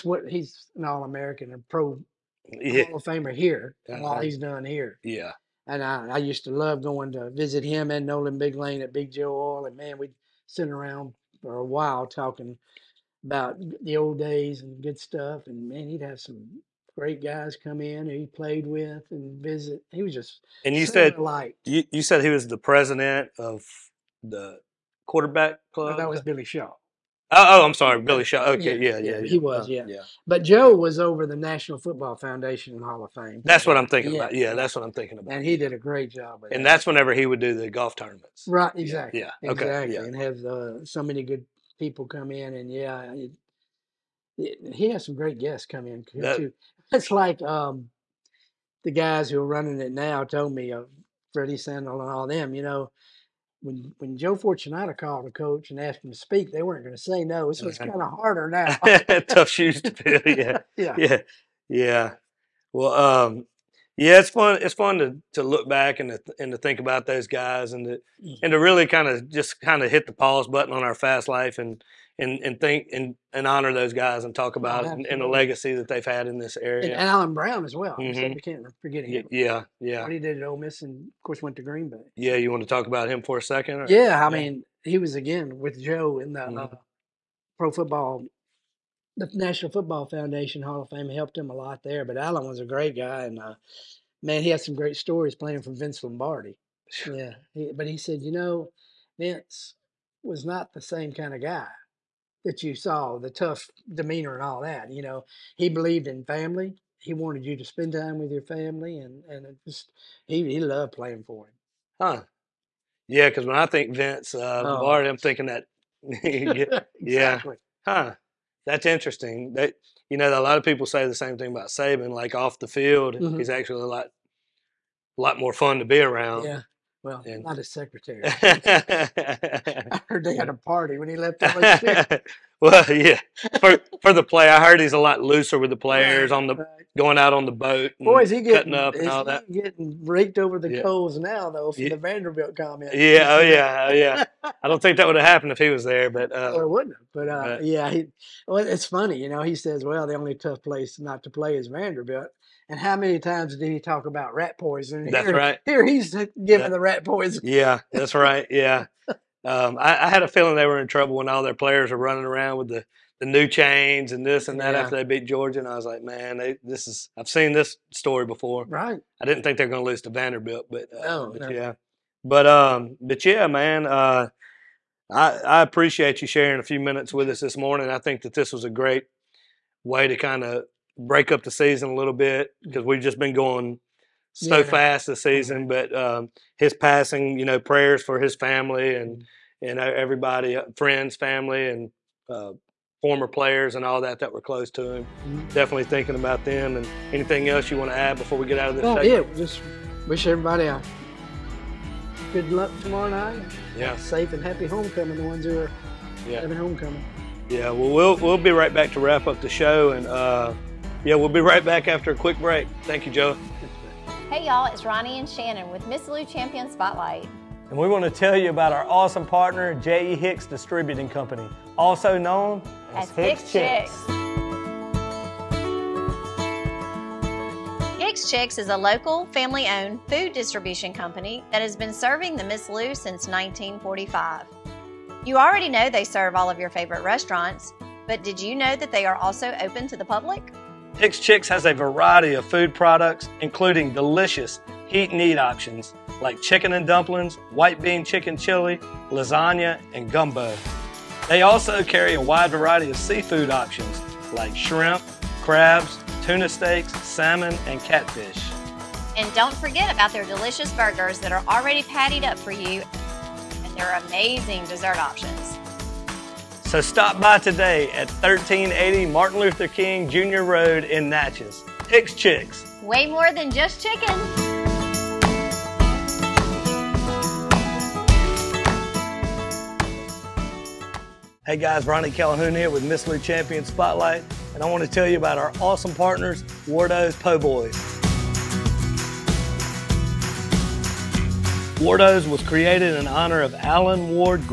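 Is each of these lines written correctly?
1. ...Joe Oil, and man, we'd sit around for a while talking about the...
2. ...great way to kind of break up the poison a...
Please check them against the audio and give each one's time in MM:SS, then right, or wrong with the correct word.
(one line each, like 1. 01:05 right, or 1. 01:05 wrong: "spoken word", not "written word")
1. 00:09 right
2. 02:58 wrong: "season", not "poison".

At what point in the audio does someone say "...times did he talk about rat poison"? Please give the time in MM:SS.
02:33.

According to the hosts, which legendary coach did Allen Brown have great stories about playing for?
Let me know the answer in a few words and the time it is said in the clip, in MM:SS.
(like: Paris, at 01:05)
Vince Lombardi, at 01:35.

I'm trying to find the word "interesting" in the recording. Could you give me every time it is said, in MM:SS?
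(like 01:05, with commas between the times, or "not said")
01:58.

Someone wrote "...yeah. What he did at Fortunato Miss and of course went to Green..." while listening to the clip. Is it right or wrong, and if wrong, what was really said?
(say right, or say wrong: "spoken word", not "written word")
wrong: "Ole", not "Fortunato".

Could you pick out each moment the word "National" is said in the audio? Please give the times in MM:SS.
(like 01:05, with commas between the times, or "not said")
00:31, 01:29.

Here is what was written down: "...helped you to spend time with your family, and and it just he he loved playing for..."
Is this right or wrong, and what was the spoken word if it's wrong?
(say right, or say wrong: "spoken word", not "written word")
wrong: "wanted", not "helped".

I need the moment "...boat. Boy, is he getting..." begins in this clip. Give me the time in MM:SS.
02:17.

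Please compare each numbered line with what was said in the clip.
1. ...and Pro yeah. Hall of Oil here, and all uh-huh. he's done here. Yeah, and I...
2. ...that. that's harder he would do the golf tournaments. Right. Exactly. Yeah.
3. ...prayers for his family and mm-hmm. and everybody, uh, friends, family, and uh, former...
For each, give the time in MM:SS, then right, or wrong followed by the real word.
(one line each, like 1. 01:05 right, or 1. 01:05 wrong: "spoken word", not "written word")
1. 00:01 wrong: "Famer", not "Oil"
2. 00:36 wrong: "whenever", not "harder"
3. 03:07 right.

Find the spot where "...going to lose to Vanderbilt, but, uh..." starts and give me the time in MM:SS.
02:49.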